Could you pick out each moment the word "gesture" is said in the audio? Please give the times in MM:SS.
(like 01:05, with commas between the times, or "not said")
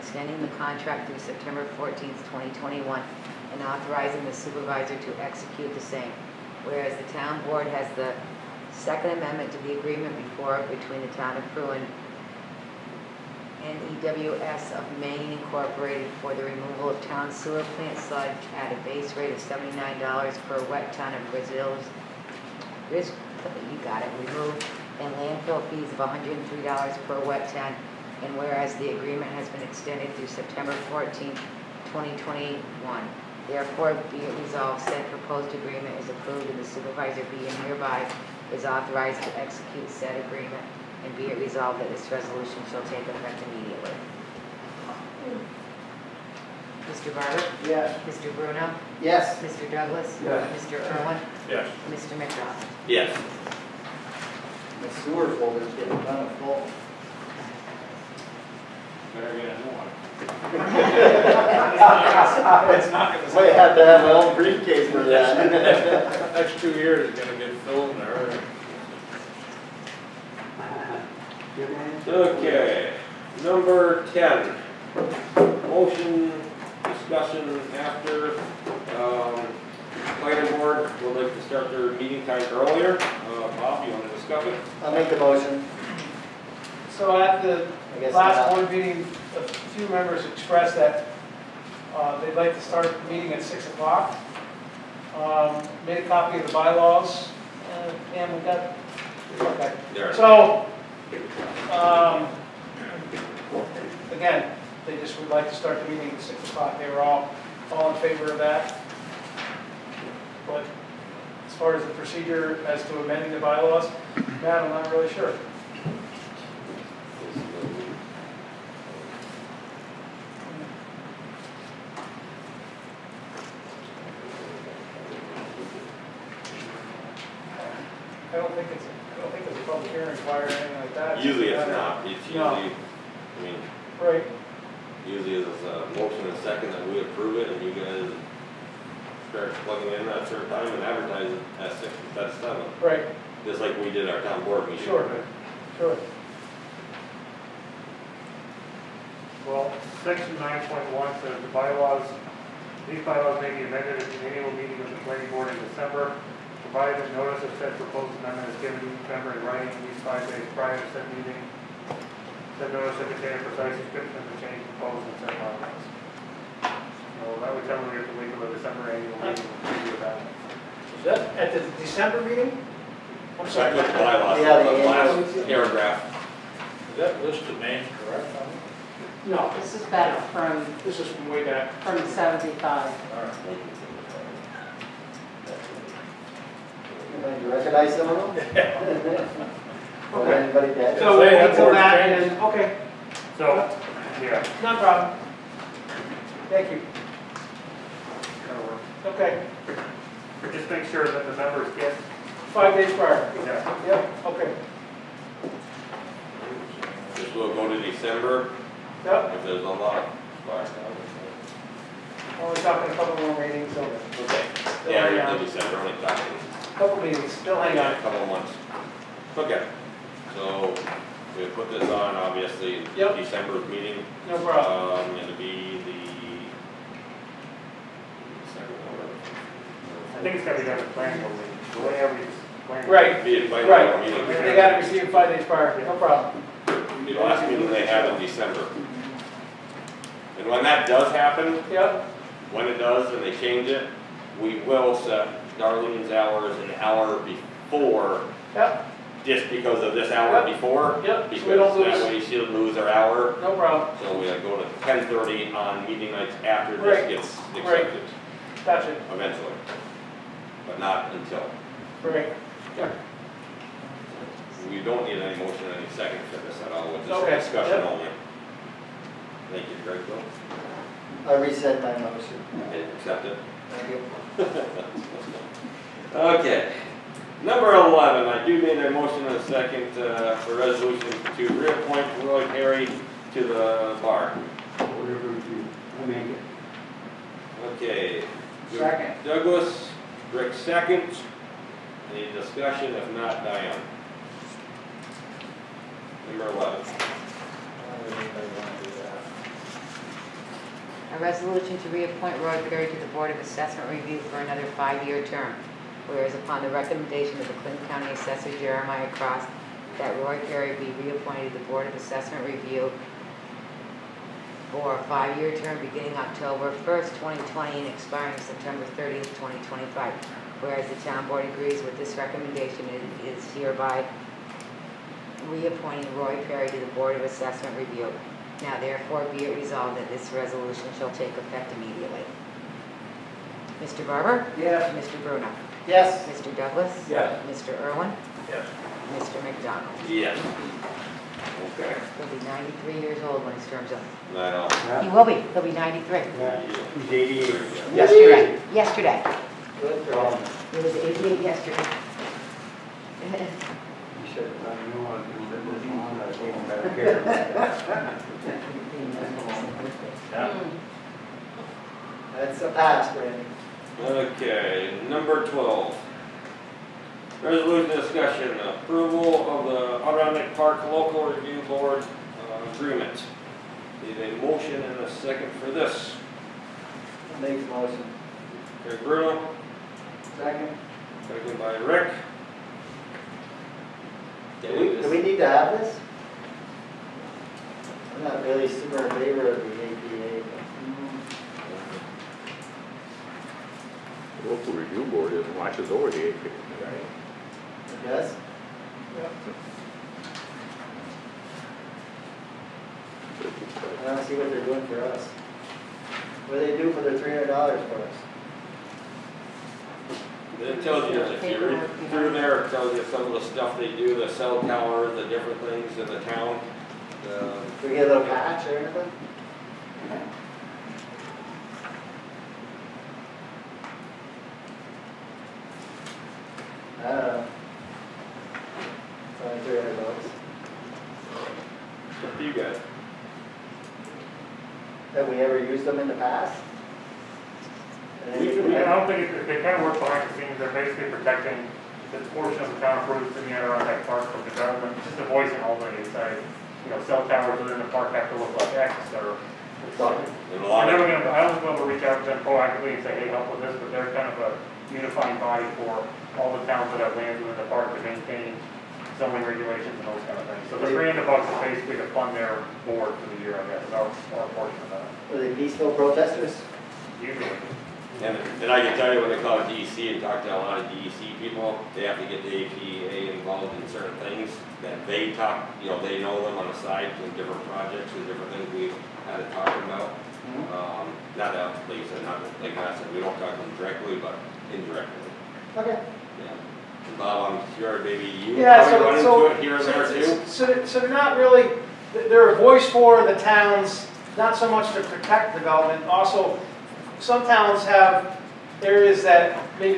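not said.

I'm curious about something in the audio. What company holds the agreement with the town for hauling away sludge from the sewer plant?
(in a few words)
EWS of Maine Incorporated.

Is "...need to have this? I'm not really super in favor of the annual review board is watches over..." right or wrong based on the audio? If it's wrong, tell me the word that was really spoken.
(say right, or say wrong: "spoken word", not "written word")
wrong: "local", not "annual".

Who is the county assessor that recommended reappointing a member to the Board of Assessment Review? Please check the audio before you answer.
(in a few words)
Jeremiah Cross.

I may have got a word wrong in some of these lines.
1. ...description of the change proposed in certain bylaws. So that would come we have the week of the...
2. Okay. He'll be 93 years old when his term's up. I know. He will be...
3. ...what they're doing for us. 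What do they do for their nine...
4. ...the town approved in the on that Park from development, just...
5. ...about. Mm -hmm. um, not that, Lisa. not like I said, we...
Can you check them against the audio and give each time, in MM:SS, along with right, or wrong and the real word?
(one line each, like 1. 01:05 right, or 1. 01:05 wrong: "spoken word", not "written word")
1. 02:43 right
2. 05:41 right
3. 06:44 wrong: "three", not "nine"
4. 07:22 right
5. 07:59 right.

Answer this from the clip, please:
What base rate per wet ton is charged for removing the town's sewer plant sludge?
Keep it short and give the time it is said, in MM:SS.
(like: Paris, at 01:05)
$79, at 00:19.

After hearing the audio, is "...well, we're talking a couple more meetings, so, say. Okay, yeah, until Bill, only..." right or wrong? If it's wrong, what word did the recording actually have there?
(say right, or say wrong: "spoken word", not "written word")
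wrong: "December", not "Bill".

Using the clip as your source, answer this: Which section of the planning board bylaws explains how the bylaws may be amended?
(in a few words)
Section 9.1.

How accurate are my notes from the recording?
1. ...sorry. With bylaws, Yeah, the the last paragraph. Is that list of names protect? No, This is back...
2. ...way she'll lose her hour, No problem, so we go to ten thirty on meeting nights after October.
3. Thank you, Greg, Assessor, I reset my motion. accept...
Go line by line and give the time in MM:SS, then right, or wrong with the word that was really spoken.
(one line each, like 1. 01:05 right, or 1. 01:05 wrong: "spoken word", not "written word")
1. 02:53 wrong: "correct", not "protect"
2. 04:12 wrong: "Right", not "October"
3. 04:29 wrong: "Bill", not "Assessor".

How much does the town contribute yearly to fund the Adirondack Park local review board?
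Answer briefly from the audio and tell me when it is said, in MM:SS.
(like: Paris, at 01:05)
$300, at 07:40.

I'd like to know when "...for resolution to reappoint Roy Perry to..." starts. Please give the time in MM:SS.
04:40.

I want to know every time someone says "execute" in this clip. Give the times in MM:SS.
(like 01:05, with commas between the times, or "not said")
00:05, 00:39.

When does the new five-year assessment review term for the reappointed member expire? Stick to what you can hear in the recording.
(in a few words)
September 30th, 2025.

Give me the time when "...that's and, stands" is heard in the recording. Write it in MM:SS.
03:11.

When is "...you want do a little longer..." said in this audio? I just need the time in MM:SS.
05:54.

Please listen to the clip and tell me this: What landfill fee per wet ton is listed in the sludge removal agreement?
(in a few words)
$103.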